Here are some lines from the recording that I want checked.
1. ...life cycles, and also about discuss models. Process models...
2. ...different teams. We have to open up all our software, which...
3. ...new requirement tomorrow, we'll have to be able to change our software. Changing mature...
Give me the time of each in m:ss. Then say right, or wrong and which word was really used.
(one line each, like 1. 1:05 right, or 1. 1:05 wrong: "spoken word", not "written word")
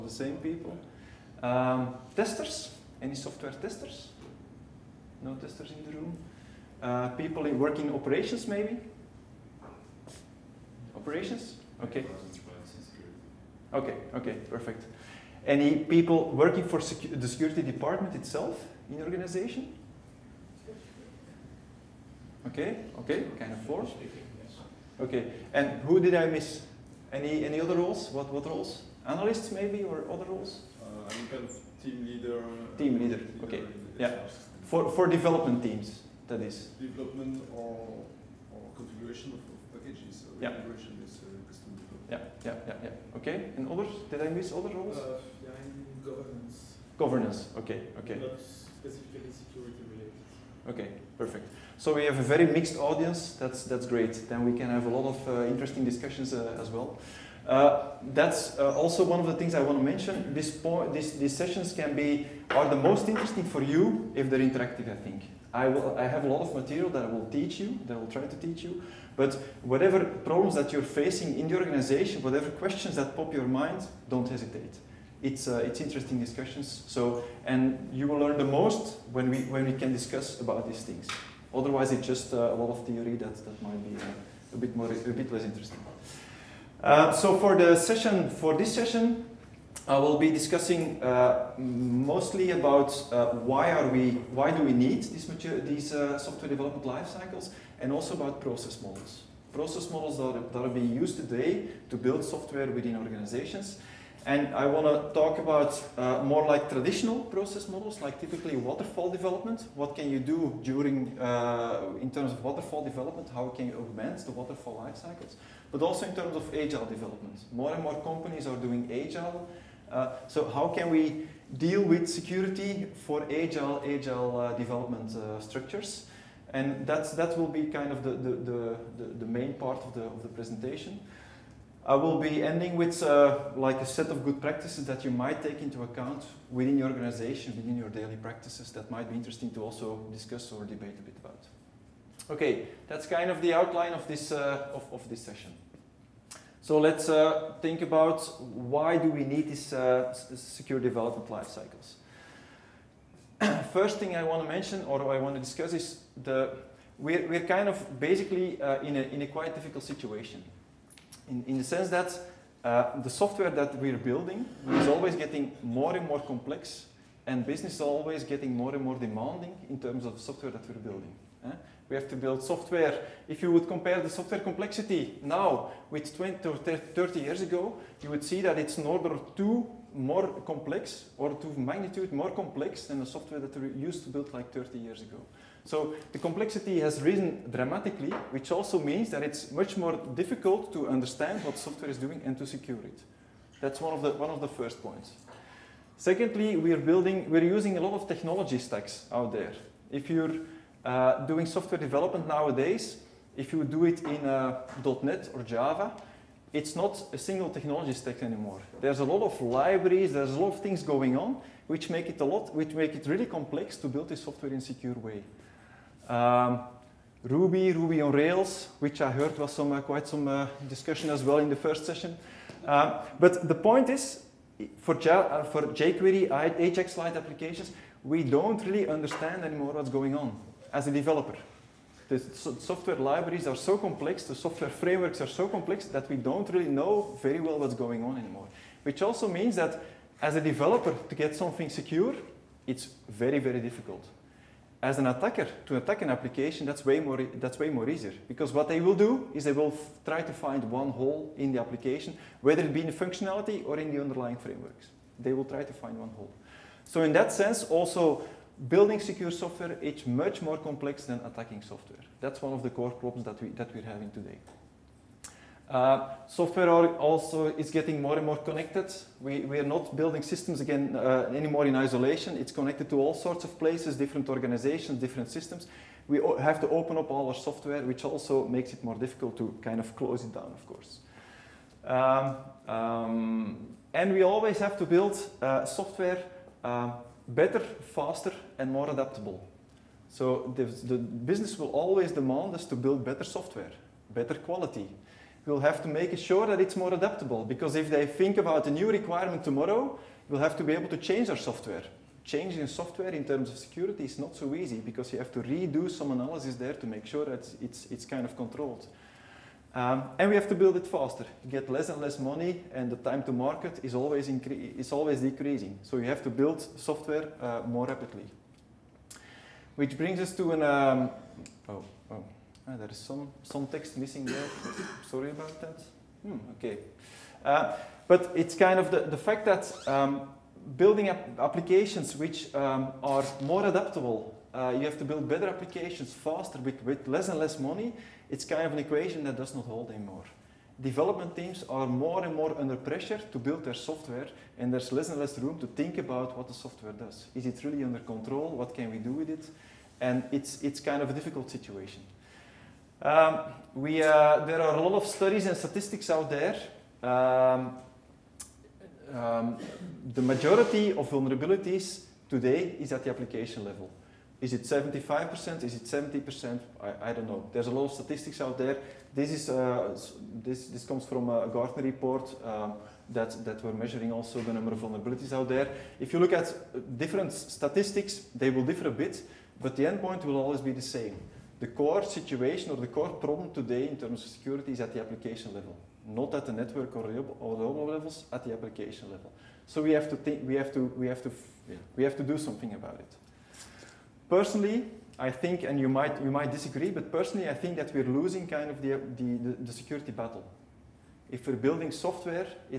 1. 1:36 wrong: "process", not "discuss"
2. 4:34 wrong: "systems", not "teams"
3. 4:58 wrong: "software", not "mature".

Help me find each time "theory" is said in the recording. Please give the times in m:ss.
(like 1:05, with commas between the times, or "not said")
1:22.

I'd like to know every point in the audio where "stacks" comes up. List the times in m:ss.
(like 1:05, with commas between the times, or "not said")
3:18, 3:27.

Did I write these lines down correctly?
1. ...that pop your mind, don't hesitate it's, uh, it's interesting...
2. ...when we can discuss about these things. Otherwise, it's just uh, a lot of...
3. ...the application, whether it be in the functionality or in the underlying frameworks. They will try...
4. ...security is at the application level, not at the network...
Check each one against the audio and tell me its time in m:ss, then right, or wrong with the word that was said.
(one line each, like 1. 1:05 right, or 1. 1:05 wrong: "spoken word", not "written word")
1. 1:12 right
2. 1:19 right
3. 4:11 right
4. 6:24 right.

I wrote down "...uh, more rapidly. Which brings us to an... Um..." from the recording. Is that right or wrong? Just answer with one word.
right.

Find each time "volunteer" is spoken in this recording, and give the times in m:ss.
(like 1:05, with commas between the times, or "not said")
not said.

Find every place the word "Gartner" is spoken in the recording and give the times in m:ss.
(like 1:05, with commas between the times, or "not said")
6:11.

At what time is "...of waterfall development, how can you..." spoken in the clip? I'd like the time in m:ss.
1:52.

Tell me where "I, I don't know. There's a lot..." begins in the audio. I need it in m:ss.
6:06.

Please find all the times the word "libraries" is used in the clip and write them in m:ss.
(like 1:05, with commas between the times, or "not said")
3:29, 3:52.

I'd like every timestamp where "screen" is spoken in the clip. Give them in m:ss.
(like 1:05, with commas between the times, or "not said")
not said.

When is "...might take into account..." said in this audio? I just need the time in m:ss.
2:15.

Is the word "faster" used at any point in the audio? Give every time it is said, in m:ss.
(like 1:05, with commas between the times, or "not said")
4:47, 5:10, 5:36.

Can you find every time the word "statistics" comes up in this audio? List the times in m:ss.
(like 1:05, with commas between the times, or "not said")
5:55, 6:07, 6:17.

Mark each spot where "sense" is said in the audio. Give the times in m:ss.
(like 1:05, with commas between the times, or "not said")
2:41, 4:17.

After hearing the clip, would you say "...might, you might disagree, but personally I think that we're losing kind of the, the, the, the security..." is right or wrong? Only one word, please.
right.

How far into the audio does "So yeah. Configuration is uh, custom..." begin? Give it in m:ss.
0:40.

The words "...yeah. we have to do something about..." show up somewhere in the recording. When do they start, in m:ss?
6:31.